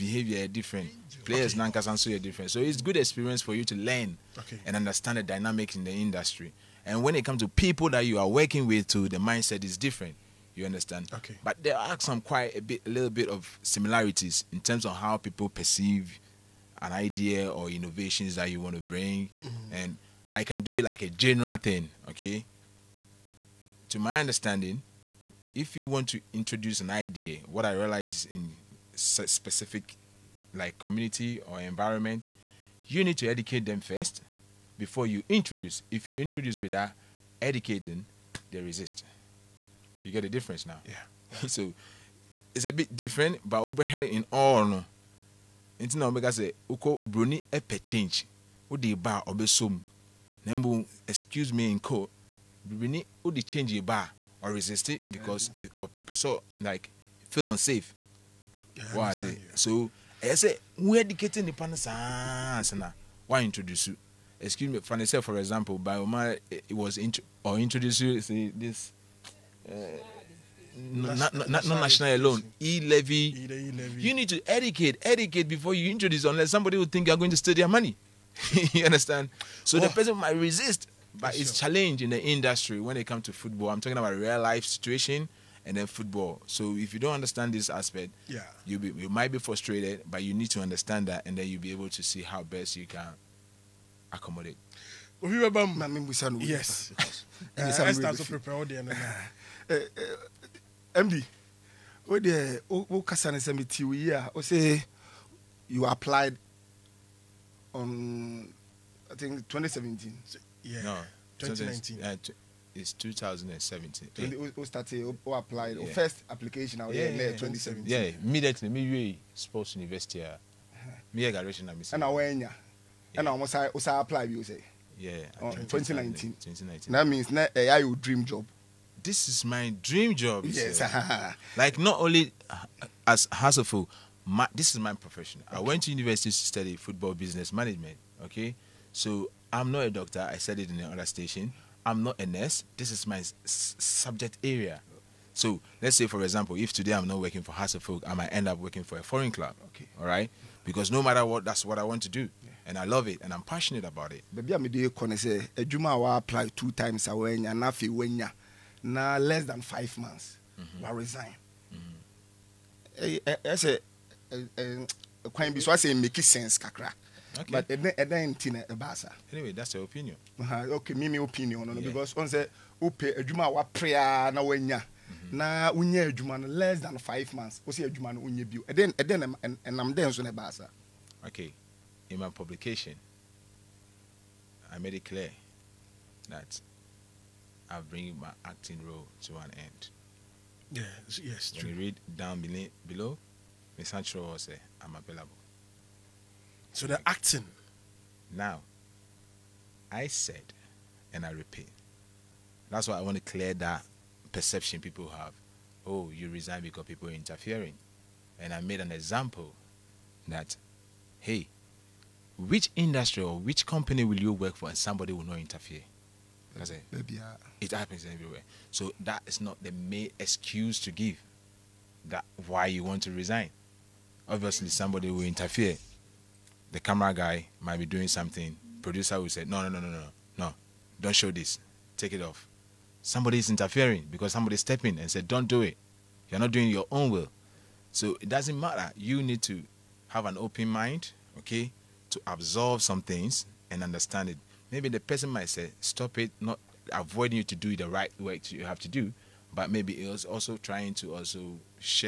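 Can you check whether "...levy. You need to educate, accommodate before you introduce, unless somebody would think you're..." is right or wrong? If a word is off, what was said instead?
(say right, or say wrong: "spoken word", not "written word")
wrong: "educate", not "accommodate".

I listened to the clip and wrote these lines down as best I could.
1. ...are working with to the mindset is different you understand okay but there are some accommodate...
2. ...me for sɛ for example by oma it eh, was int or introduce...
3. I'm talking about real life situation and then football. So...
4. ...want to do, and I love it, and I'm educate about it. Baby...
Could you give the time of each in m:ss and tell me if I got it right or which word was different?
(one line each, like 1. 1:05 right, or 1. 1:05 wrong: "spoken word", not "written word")
1. 0:08 wrong: "quite", not "accommodate"
2. 1:04 right
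3. 1:23 right
4. 2:31 wrong: "passionate", not "educate".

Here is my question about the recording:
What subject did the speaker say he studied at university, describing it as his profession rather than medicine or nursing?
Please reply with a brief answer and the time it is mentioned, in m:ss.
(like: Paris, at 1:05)
football business management, at 2:16.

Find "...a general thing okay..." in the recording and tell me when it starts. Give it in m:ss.
0:21.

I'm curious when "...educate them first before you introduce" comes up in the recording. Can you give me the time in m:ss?
0:33.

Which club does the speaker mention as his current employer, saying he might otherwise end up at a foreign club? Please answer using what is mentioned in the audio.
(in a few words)
Hearts of Oak.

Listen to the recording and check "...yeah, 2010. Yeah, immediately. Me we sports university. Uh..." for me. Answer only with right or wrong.
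wrong.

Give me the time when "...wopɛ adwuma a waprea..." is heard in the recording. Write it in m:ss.
2:52.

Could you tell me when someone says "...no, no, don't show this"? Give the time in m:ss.
3:49.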